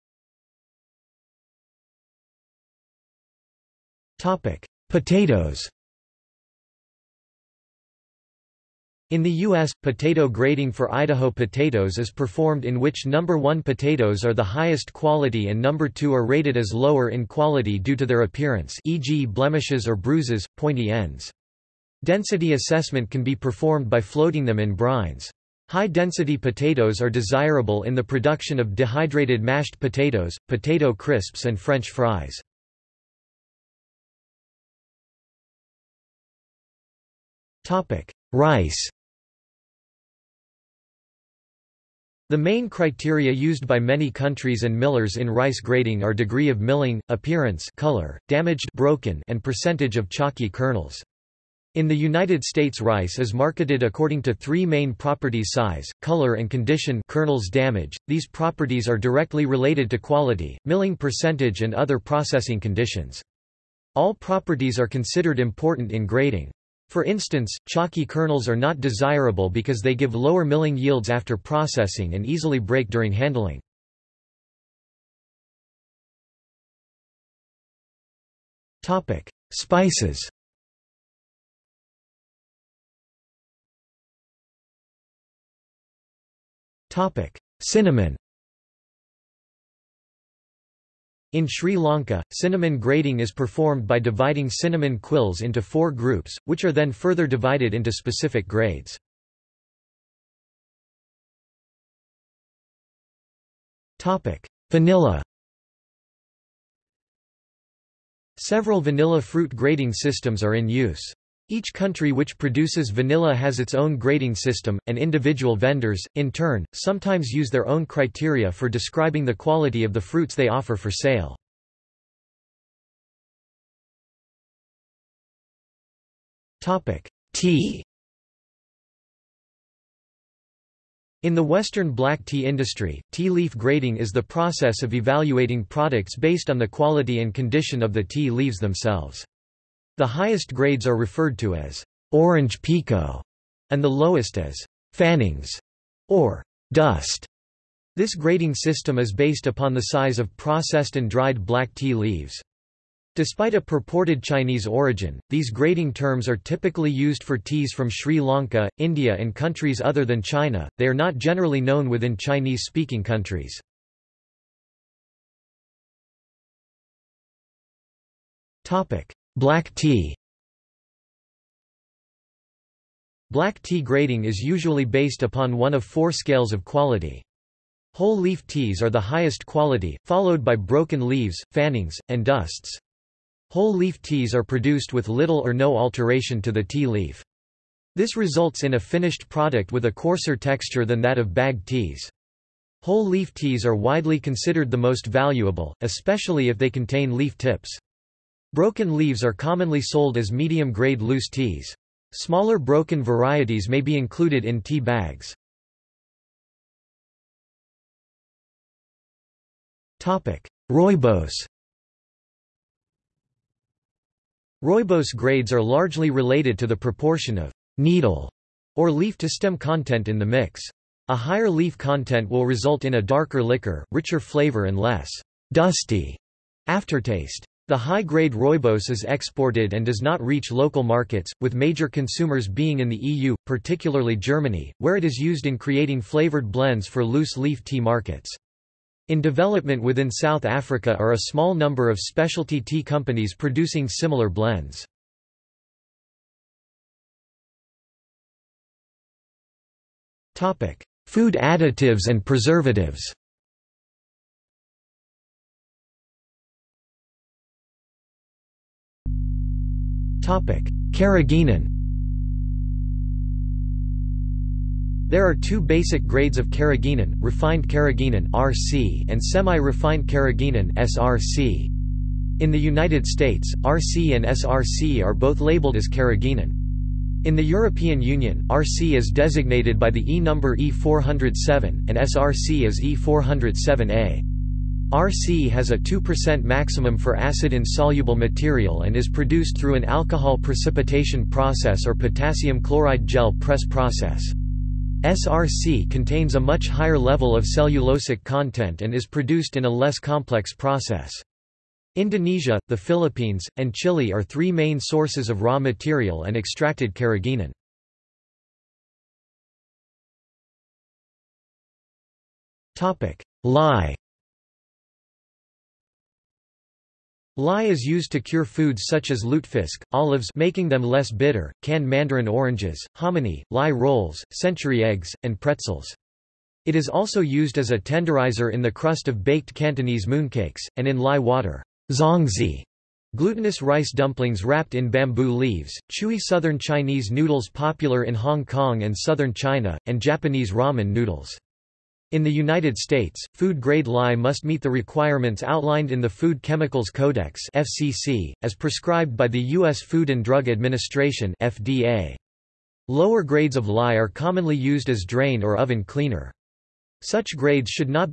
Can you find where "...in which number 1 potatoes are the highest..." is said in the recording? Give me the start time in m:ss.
0:12.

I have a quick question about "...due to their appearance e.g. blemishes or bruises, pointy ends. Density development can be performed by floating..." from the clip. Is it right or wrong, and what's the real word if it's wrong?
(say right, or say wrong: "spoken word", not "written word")
wrong: "assessment", not "development".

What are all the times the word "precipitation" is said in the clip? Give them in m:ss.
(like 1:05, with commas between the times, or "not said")
4:50.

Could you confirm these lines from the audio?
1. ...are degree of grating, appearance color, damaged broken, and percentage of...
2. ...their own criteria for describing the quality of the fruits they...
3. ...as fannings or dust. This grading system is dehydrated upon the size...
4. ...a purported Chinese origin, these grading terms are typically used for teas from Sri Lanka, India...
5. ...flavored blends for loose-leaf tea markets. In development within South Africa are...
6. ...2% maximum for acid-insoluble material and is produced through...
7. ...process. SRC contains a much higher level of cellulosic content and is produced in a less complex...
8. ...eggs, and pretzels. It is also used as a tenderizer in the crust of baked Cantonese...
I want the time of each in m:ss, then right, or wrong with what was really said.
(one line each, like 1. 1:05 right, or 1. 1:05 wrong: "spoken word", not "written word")
1. 0:46 wrong: "milling", not "grating"
2. 1:57 right
3. 2:24 wrong: "based", not "dehydrated"
4. 2:33 right
5. 3:56 right
6. 4:45 right
7. 4:53 right
8. 5:24 right.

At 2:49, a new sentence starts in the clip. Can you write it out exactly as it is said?
Black tea Black tea grading is usually based upon one of four scales of quality.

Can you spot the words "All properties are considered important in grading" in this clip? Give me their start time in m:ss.
1:03.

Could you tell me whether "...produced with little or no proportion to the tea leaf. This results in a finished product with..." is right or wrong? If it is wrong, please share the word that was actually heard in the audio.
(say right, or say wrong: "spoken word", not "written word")
wrong: "alteration", not "proportion".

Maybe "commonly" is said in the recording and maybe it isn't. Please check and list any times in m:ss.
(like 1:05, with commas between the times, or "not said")
3:19, 5:54.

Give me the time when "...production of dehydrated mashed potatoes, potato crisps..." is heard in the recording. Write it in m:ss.
0:28.